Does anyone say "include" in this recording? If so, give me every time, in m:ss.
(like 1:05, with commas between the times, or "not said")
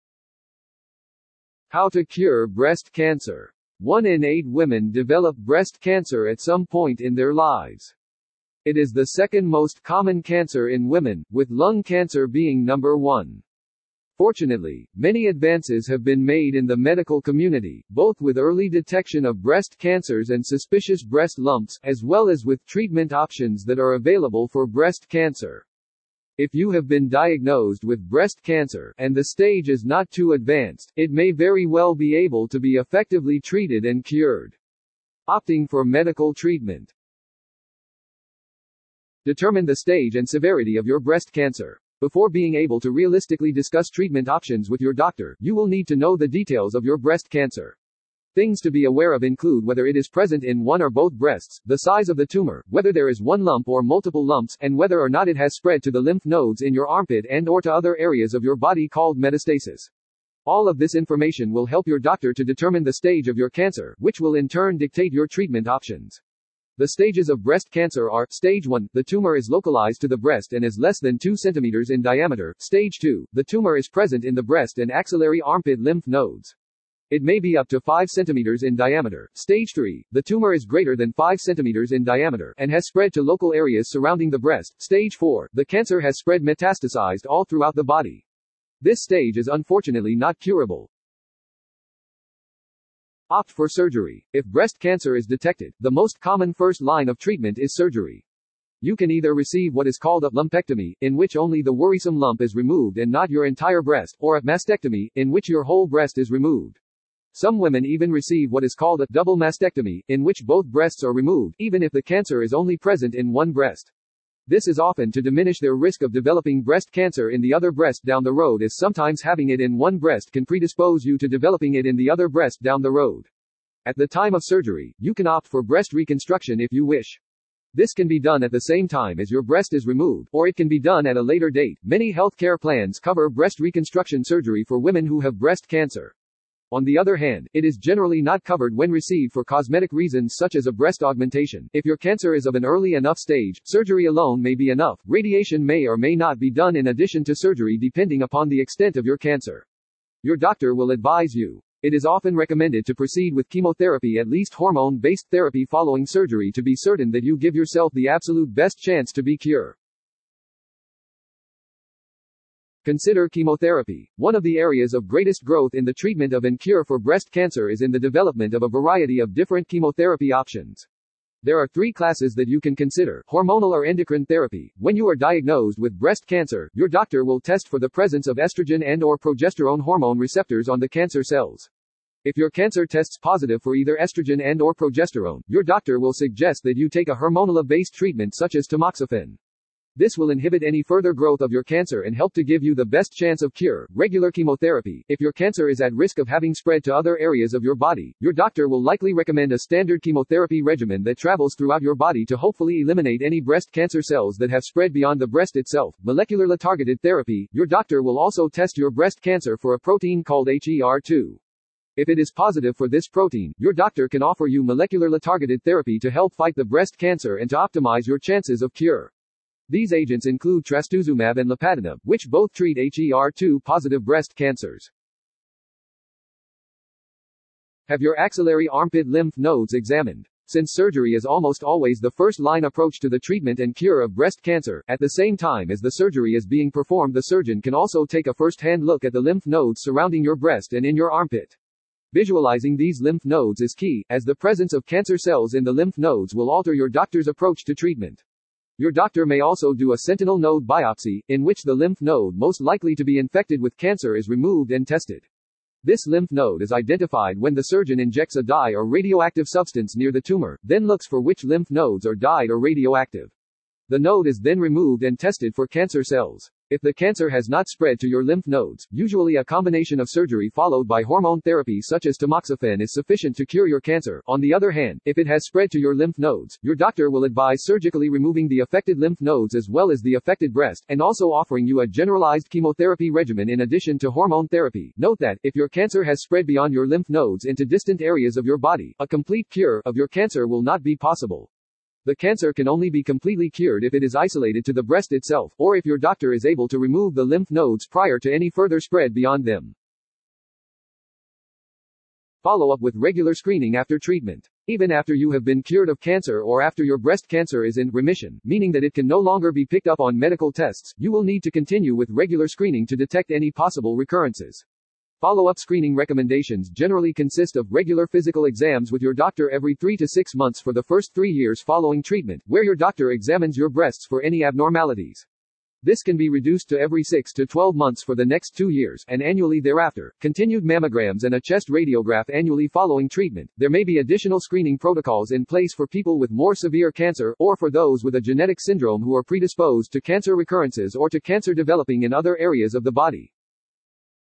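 0:49, 3:40.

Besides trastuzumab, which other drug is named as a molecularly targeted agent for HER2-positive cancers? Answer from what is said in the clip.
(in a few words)
Lapatinib.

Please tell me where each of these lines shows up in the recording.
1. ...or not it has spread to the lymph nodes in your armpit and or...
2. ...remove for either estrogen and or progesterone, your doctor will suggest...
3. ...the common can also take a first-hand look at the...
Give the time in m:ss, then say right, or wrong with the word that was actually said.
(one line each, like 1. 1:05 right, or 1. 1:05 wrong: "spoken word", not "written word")
1. 0:55 right
2. 3:03 wrong: "positive", not "remove"
3. 3:57 wrong: "surgeon", not "common".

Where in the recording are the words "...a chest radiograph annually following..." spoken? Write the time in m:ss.
5:31.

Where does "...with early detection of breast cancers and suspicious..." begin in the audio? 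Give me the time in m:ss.
0:18.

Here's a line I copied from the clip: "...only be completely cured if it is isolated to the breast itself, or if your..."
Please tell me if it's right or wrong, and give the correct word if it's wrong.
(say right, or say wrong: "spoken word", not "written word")
right.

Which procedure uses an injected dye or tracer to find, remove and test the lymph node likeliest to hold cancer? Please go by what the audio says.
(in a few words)
Sentinel node biopsy.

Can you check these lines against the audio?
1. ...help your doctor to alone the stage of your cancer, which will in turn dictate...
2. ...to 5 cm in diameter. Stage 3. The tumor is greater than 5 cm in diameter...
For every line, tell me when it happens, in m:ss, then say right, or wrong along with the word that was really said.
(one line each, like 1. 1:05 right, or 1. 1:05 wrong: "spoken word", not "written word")
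1. 1:01 wrong: "determine", not "alone"
2. 1:17 right.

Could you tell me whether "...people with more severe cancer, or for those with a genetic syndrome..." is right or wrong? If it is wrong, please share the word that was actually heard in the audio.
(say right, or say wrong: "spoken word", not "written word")
right.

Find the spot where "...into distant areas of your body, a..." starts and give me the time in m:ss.
4:47.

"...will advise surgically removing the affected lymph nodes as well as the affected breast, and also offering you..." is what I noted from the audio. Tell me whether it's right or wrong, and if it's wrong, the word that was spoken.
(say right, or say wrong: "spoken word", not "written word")
right.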